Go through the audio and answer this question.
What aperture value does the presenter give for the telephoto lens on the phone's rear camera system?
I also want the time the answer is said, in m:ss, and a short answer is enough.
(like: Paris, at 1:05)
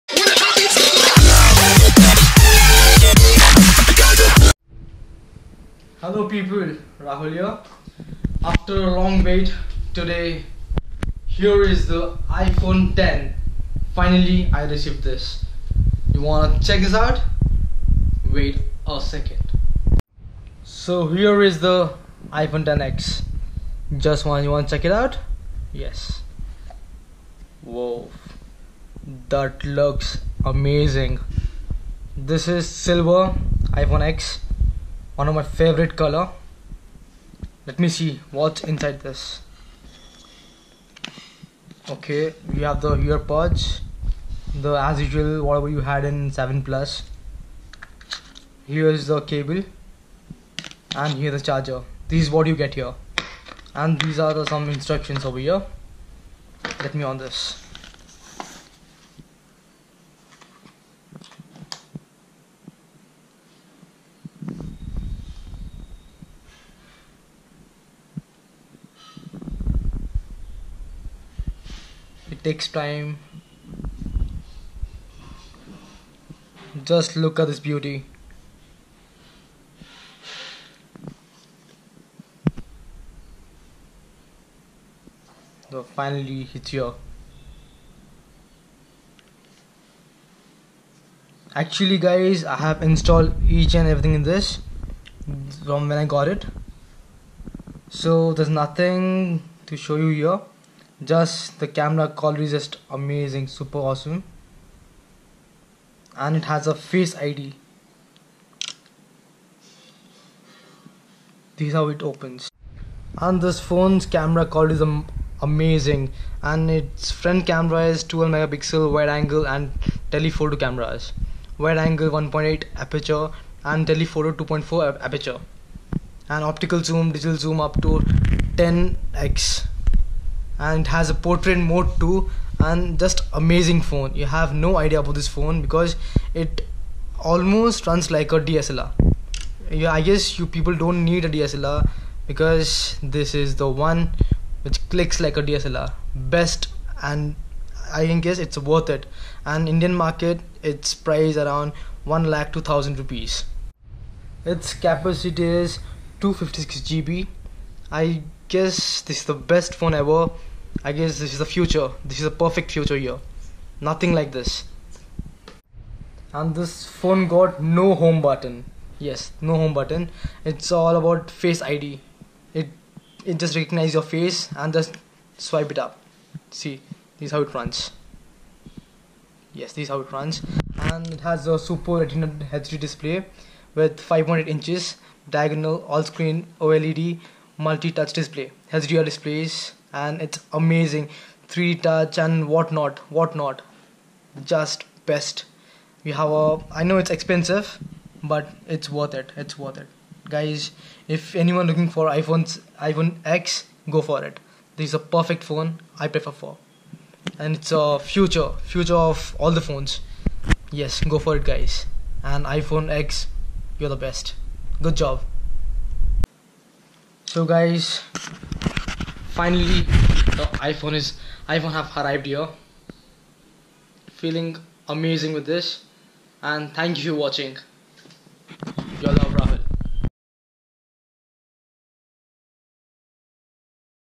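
2.4, at 2:04.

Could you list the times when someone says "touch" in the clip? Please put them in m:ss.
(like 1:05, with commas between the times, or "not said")
3:07, 3:11.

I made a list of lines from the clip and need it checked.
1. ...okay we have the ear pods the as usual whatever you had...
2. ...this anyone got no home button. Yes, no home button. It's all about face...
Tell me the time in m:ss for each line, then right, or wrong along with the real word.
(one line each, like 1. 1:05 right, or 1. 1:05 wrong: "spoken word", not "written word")
1. 0:41 right
2. 2:46 wrong: "phone", not "anyone".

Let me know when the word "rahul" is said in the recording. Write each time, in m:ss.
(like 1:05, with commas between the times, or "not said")
0:06, 3:49.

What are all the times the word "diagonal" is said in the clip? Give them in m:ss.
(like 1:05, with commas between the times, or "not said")
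3:05.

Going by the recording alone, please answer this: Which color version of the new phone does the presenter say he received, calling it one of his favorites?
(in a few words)
Silver.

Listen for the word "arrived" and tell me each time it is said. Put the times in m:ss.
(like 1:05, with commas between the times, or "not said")
3:41.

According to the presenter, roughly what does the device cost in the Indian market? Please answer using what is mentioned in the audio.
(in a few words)
1 lakh 2000 rupees.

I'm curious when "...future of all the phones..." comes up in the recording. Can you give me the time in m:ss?
3:28.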